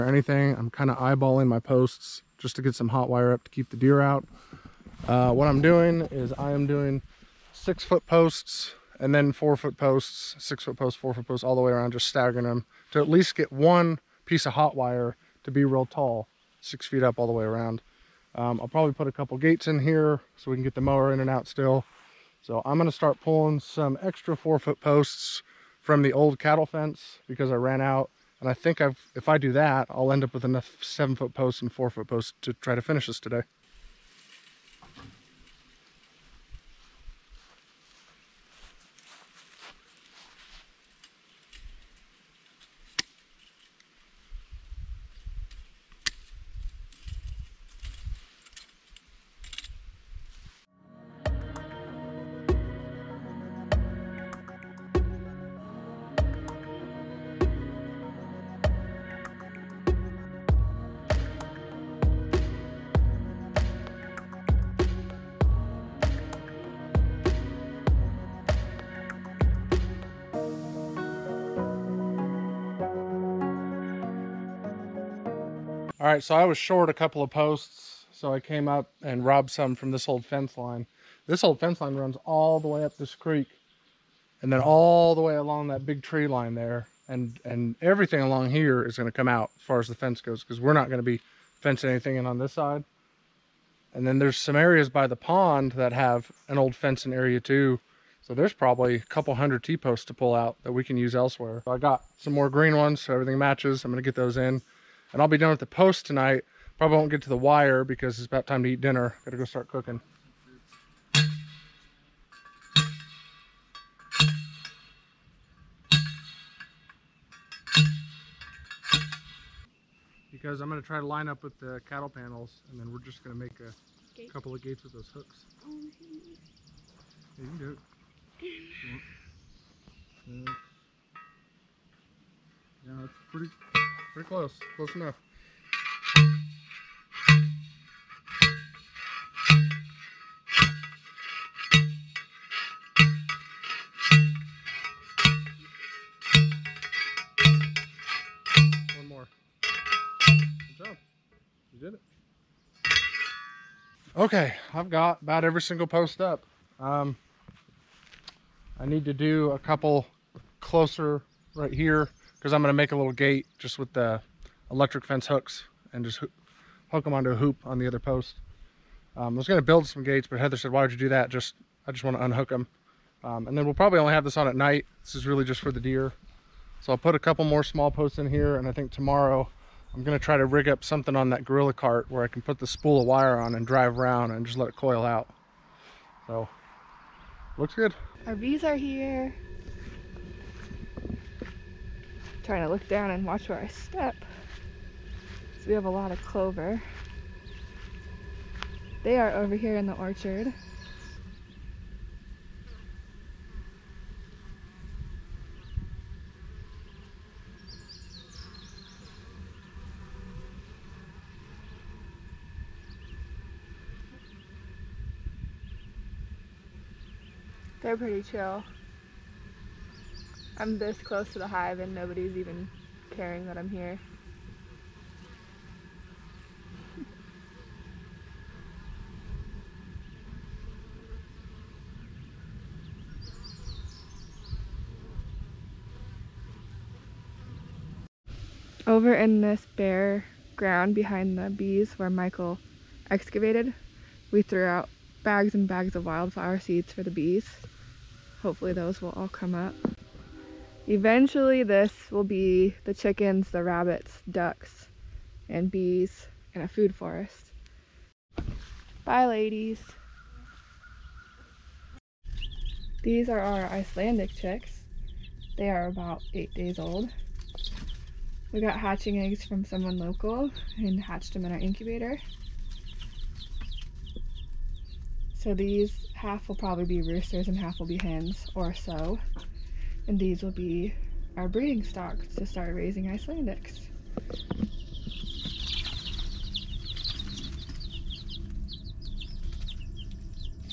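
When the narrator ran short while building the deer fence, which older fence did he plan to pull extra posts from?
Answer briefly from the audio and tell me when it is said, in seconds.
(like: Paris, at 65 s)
Old cattle fence, at 26 s.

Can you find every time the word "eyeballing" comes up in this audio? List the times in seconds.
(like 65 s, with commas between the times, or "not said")
0 s.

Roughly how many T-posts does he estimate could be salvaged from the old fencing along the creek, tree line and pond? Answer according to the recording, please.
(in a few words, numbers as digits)
A couple hundred.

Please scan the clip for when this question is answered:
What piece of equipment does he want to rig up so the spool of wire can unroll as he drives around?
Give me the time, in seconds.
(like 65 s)
181 s.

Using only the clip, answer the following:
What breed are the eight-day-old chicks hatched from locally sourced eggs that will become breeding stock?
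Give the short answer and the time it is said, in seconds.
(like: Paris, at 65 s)
Icelandic, at 263 s.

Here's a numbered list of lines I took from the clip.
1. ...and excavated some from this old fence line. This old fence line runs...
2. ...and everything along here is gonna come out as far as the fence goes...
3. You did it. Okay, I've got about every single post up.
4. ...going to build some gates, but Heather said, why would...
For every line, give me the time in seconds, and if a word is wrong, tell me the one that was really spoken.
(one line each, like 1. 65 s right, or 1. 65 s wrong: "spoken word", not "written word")
1. 79 s wrong: "robbed", not "excavated"
2. 87 s right
3. 151 s right
4. 169 s right.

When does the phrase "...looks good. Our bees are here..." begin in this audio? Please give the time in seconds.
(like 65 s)
187 s.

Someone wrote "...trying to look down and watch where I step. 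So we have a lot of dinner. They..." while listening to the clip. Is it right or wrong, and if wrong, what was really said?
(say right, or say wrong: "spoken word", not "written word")
wrong: "clover", not "dinner".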